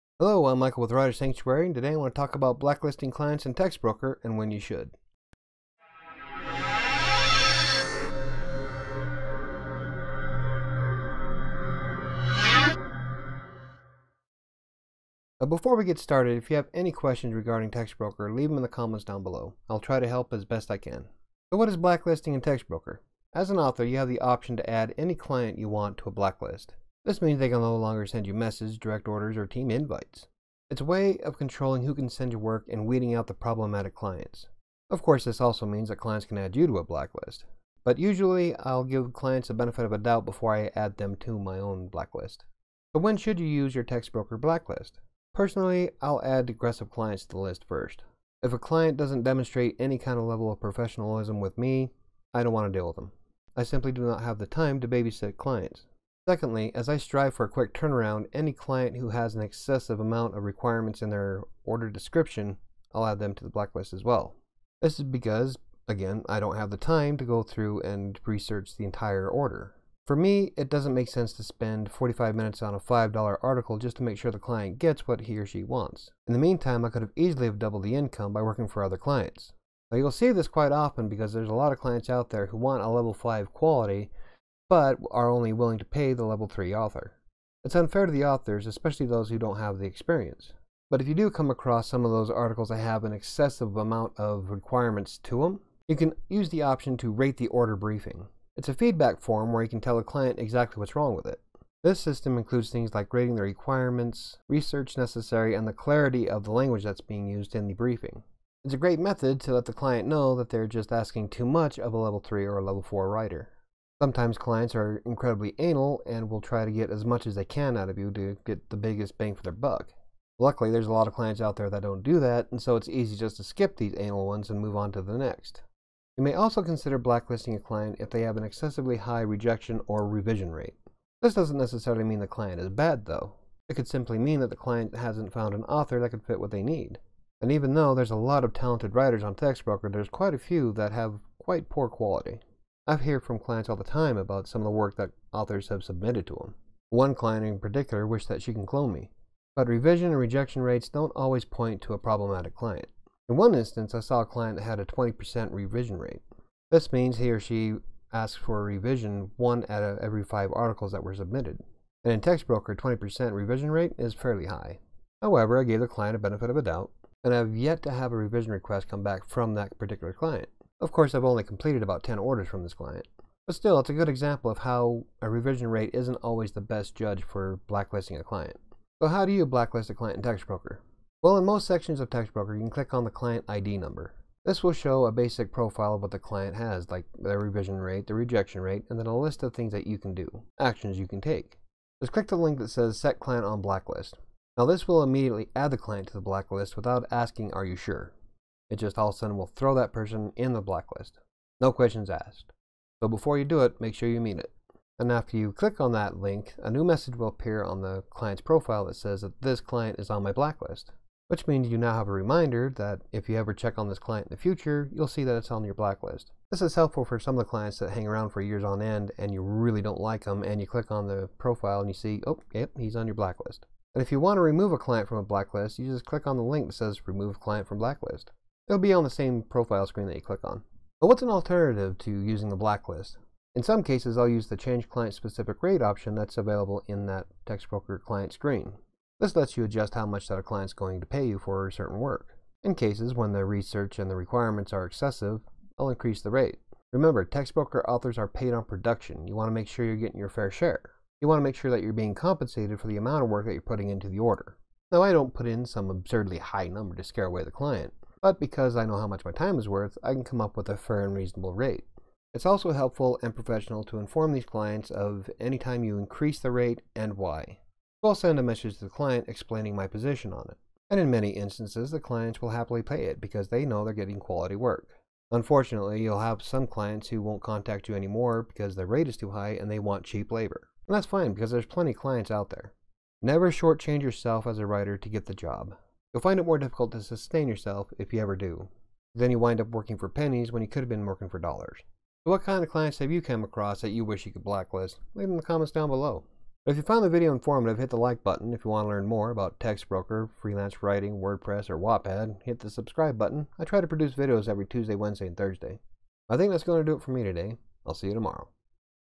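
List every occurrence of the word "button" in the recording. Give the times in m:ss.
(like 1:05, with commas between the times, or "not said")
4:58, 5:03.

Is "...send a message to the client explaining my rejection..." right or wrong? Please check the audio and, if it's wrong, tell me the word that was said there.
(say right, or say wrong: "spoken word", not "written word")
wrong: "position", not "rejection".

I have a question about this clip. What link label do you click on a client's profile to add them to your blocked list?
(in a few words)
Set Client on Blacklist.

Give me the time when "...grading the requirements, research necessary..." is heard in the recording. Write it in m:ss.
1:43.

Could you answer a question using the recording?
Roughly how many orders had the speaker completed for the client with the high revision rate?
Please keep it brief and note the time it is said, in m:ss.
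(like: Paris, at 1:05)
10, at 2:51.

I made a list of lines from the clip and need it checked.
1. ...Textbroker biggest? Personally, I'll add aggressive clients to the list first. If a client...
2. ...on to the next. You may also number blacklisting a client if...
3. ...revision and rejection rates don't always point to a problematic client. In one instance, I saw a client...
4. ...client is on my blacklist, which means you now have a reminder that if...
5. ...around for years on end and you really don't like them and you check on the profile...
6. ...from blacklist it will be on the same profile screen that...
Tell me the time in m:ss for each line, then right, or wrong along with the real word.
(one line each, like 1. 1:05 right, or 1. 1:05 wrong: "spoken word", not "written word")
1. 0:43 wrong: "blacklist", not "biggest"
2. 2:04 wrong: "consider", not "number"
3. 2:29 right
4. 3:29 right
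5. 3:38 wrong: "click", not "check"
6. 3:47 right.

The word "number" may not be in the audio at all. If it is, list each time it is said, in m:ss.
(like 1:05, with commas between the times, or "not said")
3:03, 4:16.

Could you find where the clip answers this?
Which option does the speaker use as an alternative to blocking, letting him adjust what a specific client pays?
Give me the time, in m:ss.
3:54.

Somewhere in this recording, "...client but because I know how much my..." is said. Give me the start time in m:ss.
4:17.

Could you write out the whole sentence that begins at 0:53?
I simply do not have the time to babysit clients.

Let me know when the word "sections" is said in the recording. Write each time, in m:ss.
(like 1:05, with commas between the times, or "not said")
3:01.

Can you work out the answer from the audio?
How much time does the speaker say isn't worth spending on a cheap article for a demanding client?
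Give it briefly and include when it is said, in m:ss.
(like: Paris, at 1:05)
45 minutes, at 1:11.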